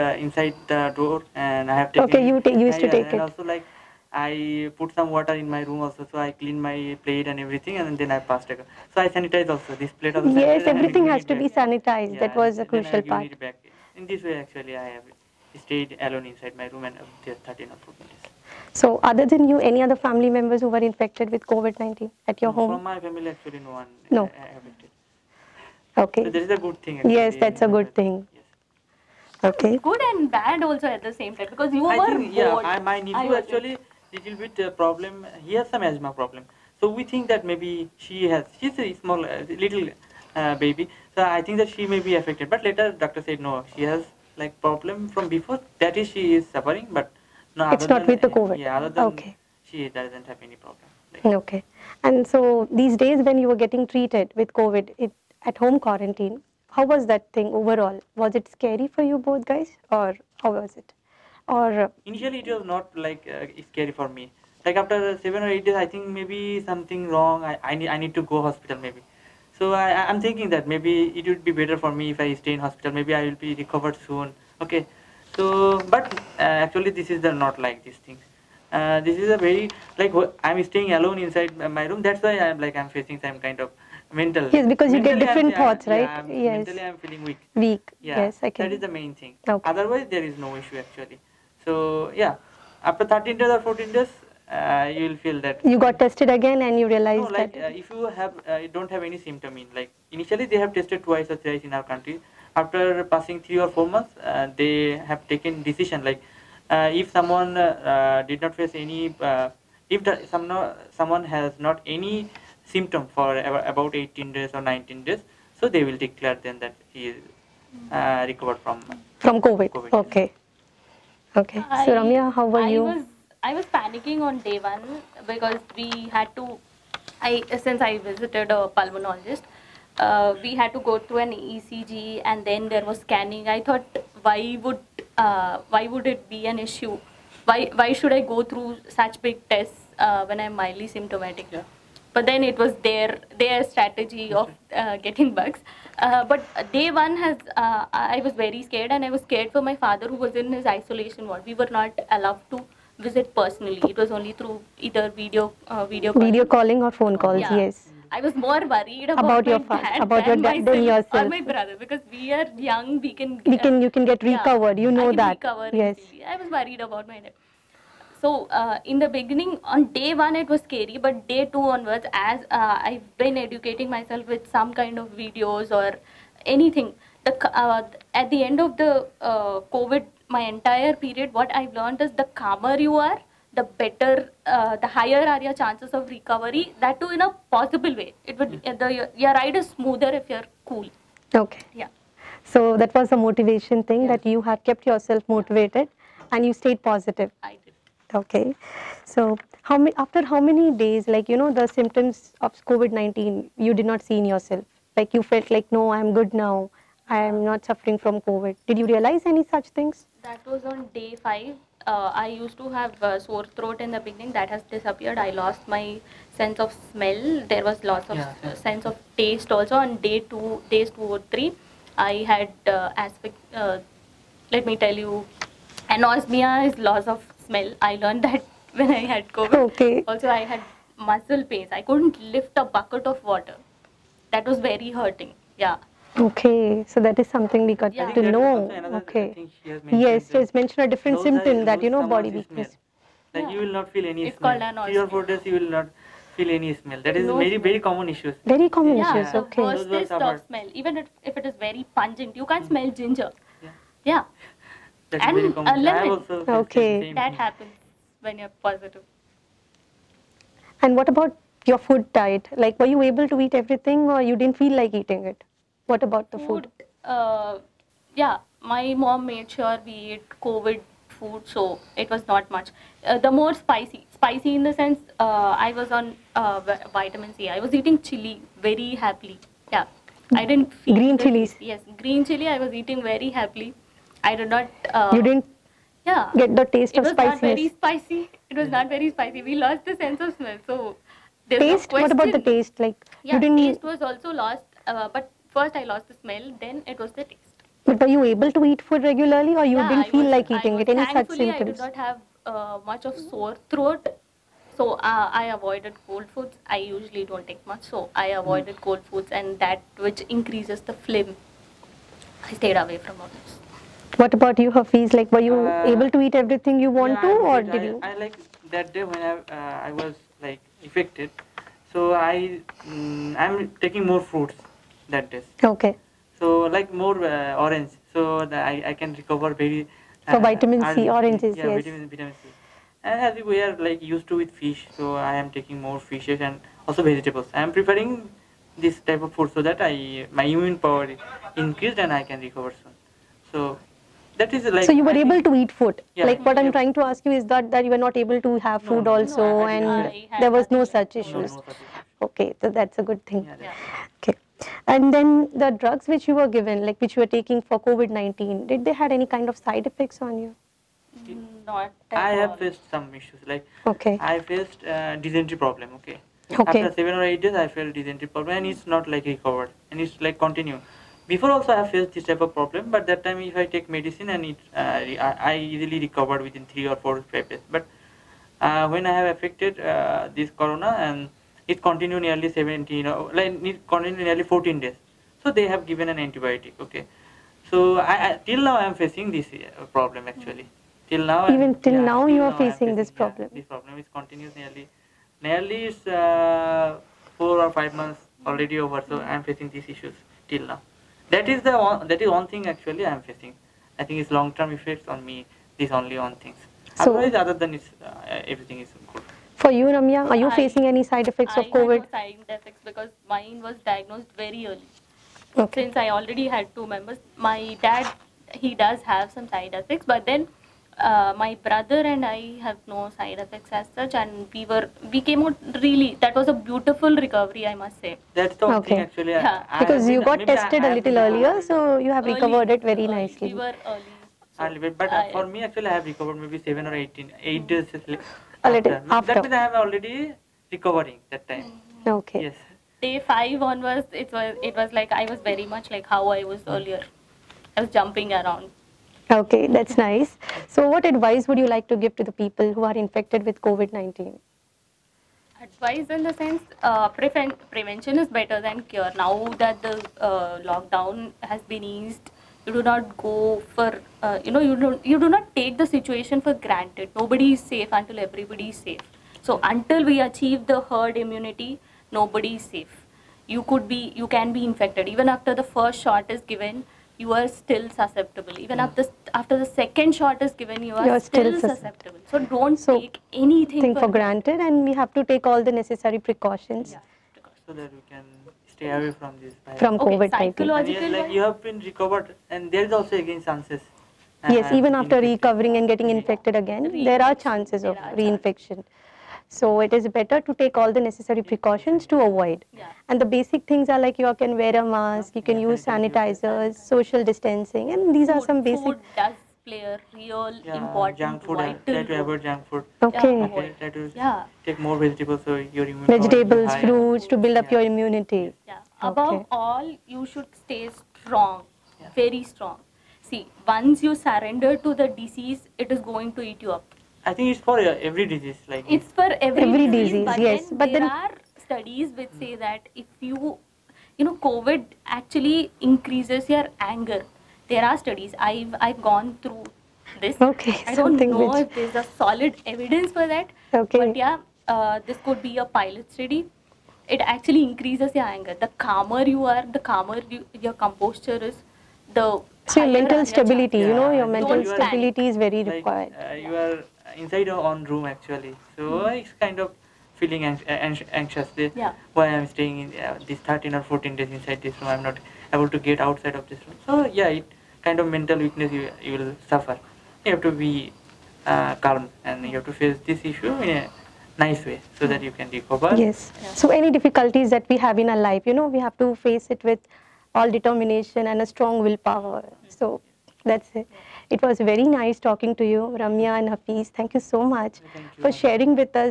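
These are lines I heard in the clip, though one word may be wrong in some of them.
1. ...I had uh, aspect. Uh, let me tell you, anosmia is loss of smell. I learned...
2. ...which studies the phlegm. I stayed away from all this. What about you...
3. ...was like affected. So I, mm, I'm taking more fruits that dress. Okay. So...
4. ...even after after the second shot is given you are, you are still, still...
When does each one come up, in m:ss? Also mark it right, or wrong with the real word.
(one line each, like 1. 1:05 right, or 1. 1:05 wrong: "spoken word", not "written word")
1. 3:41 right
2. 5:10 wrong: "increases", not "studies"
3. 5:19 right
4. 7:58 right.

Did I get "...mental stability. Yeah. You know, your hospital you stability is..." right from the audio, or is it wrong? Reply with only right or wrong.
wrong.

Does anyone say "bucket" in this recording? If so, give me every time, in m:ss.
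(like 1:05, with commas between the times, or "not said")
3:52.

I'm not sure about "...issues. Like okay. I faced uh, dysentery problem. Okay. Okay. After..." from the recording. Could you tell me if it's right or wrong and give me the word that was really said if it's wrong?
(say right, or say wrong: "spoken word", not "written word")
right.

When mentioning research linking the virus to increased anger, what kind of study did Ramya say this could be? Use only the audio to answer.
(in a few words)
pilot study.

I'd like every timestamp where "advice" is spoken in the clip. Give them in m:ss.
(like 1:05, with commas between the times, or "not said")
7:31, 7:35.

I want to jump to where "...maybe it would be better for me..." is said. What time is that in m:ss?
1:10.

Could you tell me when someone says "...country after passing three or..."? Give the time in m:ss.
1:41.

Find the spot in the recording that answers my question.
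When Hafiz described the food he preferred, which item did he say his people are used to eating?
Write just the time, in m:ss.
5:34.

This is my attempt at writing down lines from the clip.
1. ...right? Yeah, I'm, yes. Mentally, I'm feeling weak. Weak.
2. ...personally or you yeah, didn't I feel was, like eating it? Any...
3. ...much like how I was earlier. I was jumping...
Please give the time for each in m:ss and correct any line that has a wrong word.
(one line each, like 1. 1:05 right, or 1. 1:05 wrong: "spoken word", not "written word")
1. 1:25 right
2. 4:59 wrong: "regularly", not "personally"
3. 7:25 right.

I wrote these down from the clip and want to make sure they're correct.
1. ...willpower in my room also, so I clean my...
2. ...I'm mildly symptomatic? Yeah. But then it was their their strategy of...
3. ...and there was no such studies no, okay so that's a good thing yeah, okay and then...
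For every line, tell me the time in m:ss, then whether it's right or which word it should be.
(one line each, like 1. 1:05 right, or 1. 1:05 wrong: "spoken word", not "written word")
1. 0:05 wrong: "water", not "willpower"
2. 2:20 right
3. 5:49 wrong: "issues", not "studies".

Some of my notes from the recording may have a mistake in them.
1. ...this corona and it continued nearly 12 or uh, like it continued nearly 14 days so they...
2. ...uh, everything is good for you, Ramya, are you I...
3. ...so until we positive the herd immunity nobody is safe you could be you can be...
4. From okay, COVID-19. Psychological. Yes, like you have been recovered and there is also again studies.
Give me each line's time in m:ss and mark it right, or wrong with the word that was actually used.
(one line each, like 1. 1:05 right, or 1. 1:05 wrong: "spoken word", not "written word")
1. 6:20 wrong: "17", not "12"
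2. 6:48 right
3. 7:49 wrong: "achieve", not "positive"
4. 8:09 wrong: "chances", not "studies".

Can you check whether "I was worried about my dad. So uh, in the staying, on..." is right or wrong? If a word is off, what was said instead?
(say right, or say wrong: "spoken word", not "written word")
wrong: "beginning", not "staying".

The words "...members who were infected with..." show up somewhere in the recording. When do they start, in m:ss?
0:20.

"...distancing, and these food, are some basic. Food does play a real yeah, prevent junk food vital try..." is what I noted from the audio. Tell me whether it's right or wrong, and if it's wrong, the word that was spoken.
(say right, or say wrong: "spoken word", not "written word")
wrong: "important", not "prevent".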